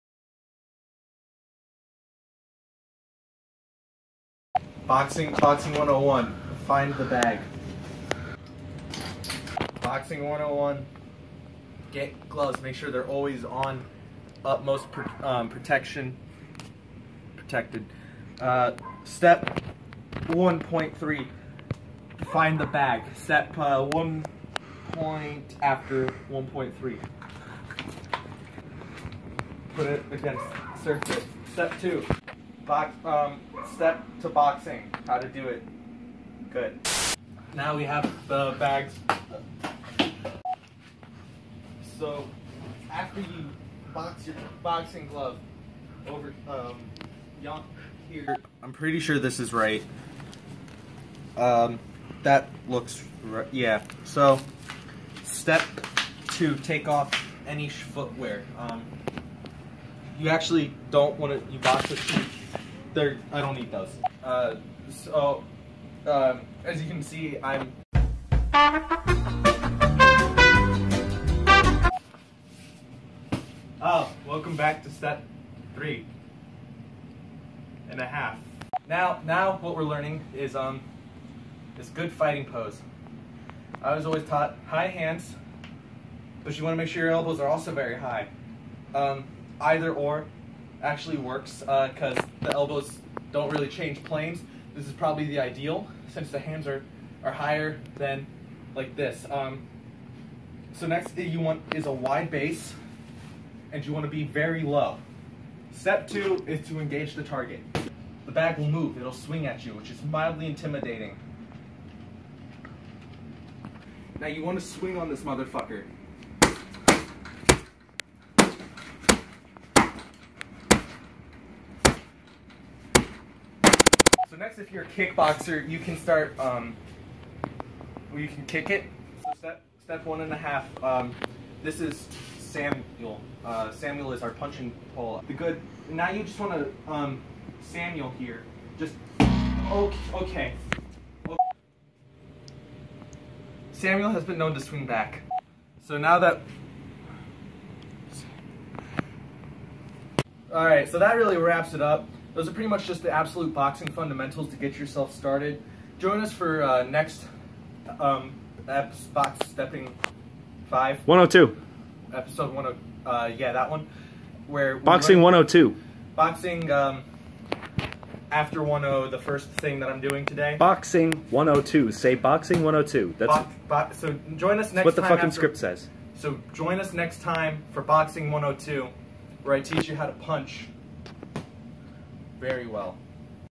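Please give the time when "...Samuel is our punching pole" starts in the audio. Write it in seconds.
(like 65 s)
133 s.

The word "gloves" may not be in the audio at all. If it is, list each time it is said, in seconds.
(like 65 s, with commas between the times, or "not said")
12 s, 45 s.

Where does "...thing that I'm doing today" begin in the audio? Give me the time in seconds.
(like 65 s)
169 s.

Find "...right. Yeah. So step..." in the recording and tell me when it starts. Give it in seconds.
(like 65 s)
53 s.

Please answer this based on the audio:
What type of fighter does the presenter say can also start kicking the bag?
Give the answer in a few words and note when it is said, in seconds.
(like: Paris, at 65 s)
Kickboxer, at 124 s.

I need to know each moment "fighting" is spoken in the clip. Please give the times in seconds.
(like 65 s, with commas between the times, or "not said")
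82 s.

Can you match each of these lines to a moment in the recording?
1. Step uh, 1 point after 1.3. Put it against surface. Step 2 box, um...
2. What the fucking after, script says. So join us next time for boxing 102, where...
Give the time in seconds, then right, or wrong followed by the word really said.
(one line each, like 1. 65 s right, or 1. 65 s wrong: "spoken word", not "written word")
1. 23 s right
2. 174 s right.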